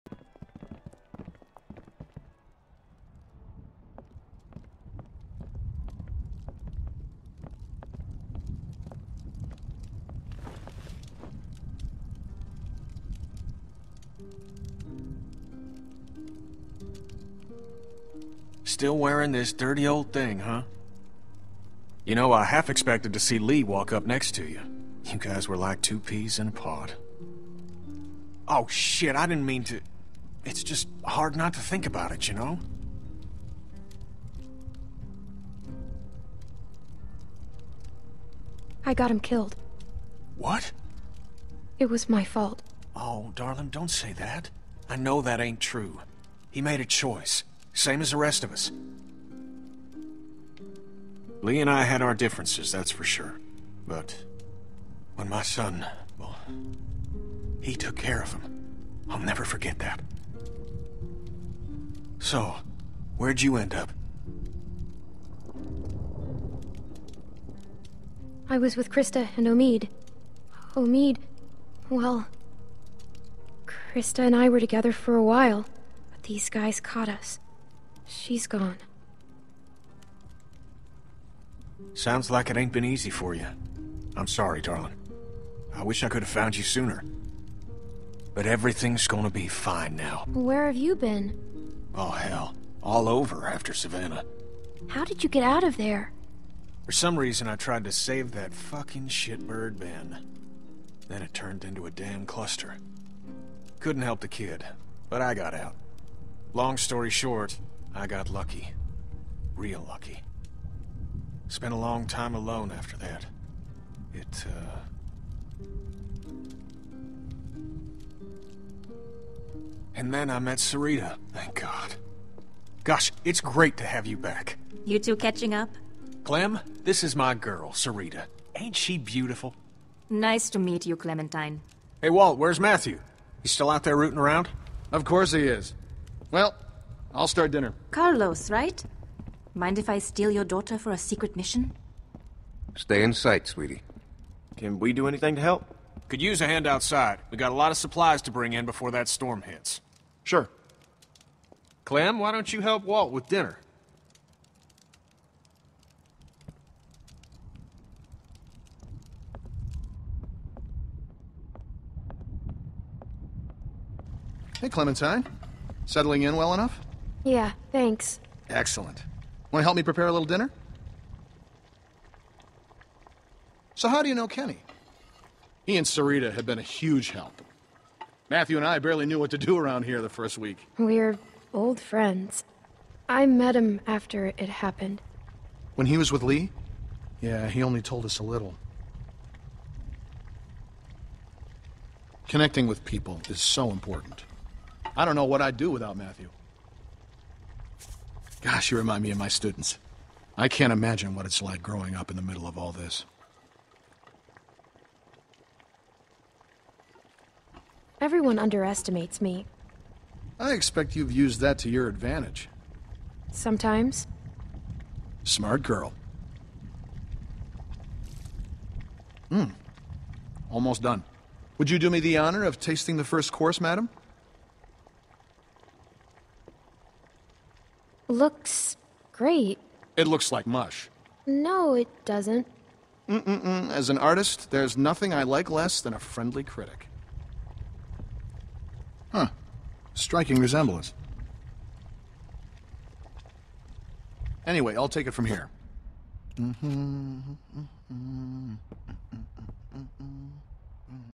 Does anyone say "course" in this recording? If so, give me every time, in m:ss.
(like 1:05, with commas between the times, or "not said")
2:15, 3:43.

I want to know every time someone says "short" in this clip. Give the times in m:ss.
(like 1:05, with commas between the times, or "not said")
1:47.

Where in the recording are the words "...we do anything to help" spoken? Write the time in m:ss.
2:24.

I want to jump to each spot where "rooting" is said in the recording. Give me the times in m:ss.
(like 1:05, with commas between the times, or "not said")
2:13.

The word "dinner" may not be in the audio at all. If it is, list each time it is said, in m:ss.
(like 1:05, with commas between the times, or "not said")
2:17, 2:33, 2:50.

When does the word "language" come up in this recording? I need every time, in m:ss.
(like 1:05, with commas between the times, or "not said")
not said.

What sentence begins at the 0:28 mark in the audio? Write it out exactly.
Oh shit, I didn't mean to...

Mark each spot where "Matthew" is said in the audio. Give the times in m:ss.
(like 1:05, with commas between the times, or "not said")
2:12, 2:58, 3:15.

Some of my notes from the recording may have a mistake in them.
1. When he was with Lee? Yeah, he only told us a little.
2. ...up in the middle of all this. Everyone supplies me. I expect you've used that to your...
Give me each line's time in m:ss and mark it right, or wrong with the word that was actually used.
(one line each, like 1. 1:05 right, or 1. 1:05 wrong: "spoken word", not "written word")
1. 3:05 right
2. 3:21 wrong: "underestimates", not "supplies".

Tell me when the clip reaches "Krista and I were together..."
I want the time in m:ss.
1:13.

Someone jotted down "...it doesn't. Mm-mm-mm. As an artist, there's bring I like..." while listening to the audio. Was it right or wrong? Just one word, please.
wrong.